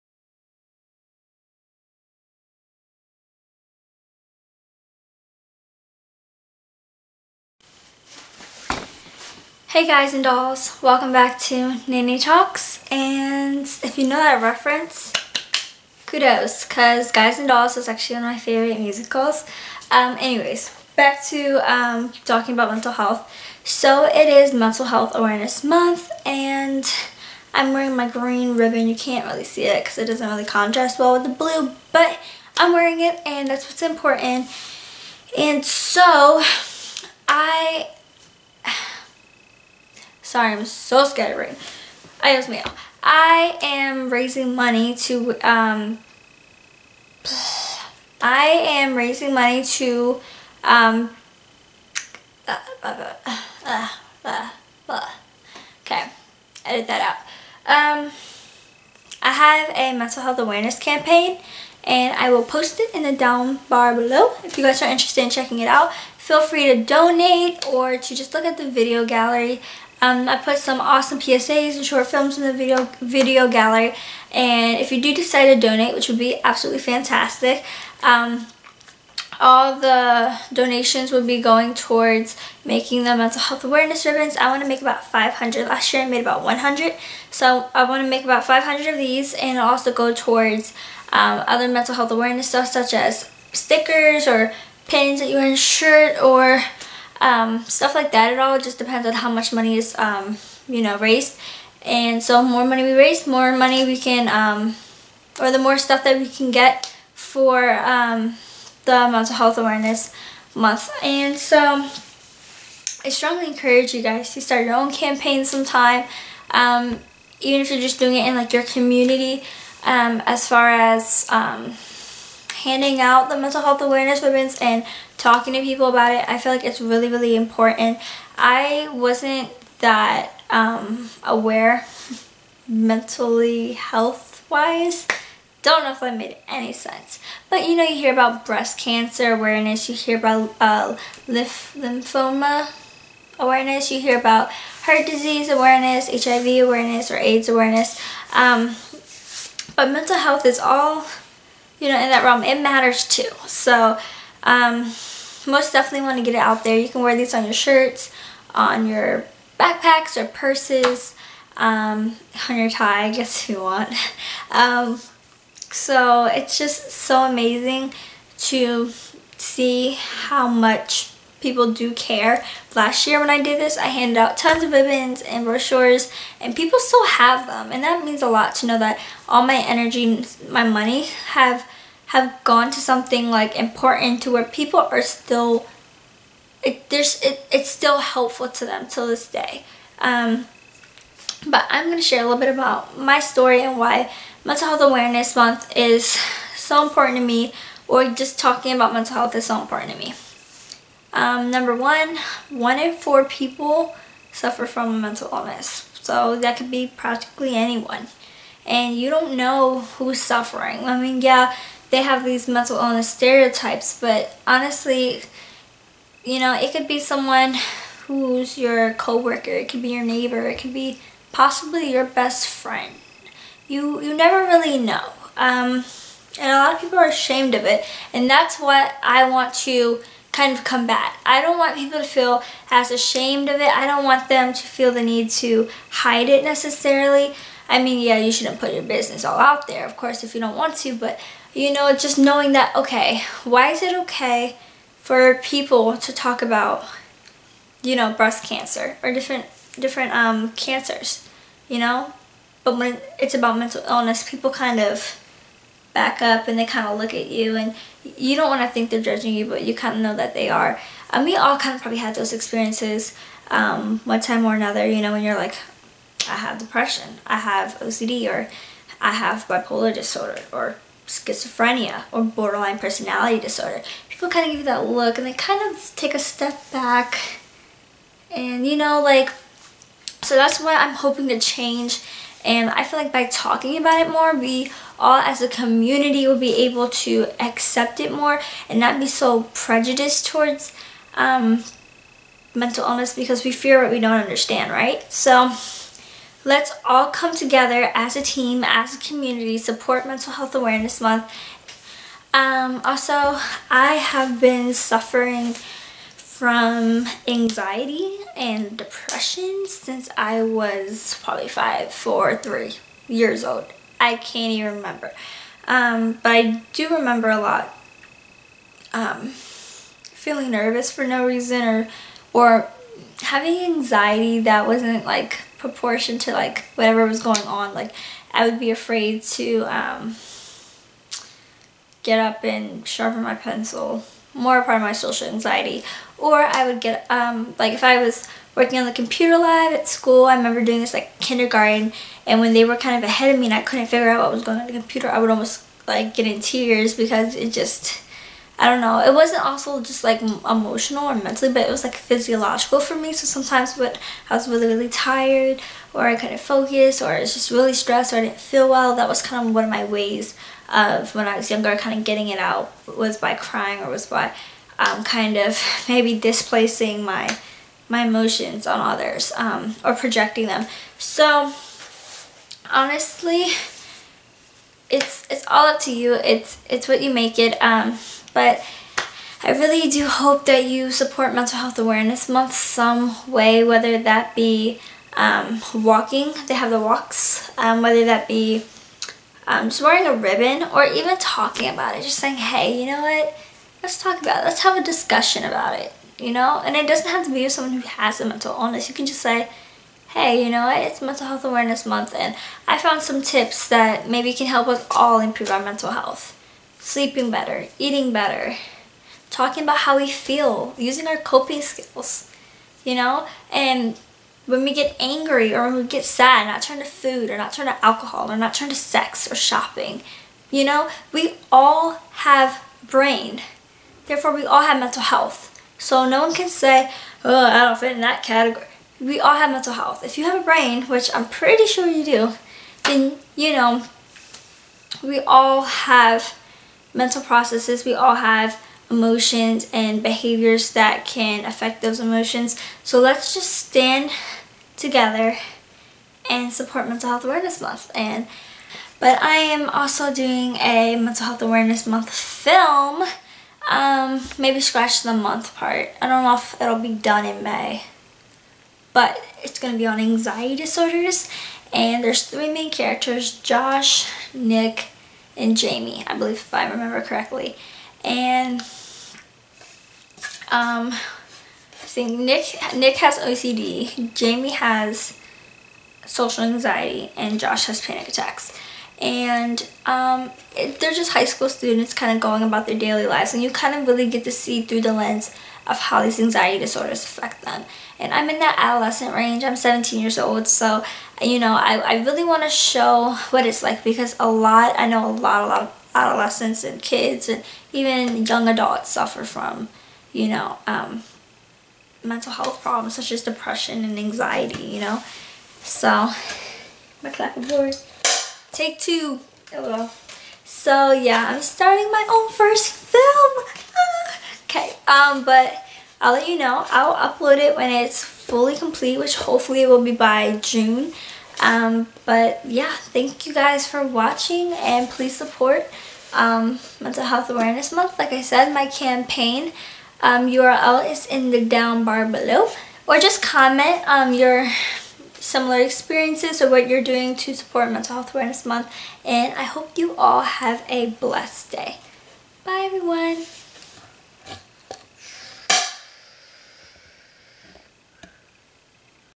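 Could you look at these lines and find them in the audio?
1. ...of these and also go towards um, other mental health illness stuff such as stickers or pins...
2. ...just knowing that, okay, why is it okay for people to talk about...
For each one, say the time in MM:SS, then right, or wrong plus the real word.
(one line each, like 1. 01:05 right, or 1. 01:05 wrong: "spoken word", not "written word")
1. 01:28 wrong: "awareness", not "illness"
2. 04:01 right.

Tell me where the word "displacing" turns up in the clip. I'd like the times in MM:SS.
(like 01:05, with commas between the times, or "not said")
06:06.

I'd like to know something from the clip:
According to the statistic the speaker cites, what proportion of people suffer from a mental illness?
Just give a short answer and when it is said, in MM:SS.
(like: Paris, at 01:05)
One in four, at 03:22.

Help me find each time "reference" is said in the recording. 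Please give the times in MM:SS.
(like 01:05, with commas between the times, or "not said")
00:14.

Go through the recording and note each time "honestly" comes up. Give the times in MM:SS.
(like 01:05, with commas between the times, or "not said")
03:34, 06:12.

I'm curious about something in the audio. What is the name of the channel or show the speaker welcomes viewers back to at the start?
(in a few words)
Nanny Talks.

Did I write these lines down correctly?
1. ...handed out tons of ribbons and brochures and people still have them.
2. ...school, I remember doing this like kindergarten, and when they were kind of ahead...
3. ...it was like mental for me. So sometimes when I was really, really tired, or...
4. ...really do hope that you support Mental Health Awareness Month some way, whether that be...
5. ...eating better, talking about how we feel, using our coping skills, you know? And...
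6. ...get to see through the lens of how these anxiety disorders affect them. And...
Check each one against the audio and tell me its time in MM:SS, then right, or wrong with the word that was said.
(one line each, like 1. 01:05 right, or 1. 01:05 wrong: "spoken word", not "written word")
1. 02:53 right
2. 05:39 right
3. 05:51 wrong: "physiological", not "mental"
4. 06:19 right
5. 06:47 right
6. 08:04 right.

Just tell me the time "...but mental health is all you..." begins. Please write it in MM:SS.
02:29.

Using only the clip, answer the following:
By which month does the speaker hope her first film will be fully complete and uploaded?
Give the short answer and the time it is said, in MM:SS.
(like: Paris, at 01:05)
June, at 08:40.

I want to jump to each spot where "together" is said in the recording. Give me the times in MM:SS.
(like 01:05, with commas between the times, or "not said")
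04:57, 07:24.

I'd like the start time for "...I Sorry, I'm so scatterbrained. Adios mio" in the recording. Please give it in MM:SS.
00:37.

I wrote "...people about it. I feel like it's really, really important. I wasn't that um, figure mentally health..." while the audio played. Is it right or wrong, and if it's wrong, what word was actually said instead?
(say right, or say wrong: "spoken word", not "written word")
wrong: "aware", not "figure".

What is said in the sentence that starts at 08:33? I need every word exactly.
Ah, okay, um, but I'll let you know.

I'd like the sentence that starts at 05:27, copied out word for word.
Like I would be afraid to um, get up and sharpen my pencil more part of my social anxiety.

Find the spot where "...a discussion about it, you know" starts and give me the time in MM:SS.
06:34.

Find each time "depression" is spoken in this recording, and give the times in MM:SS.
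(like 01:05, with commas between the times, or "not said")
04:26, 05:08, 08:23.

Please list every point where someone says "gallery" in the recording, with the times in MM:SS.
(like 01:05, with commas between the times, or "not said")
01:09, 01:13.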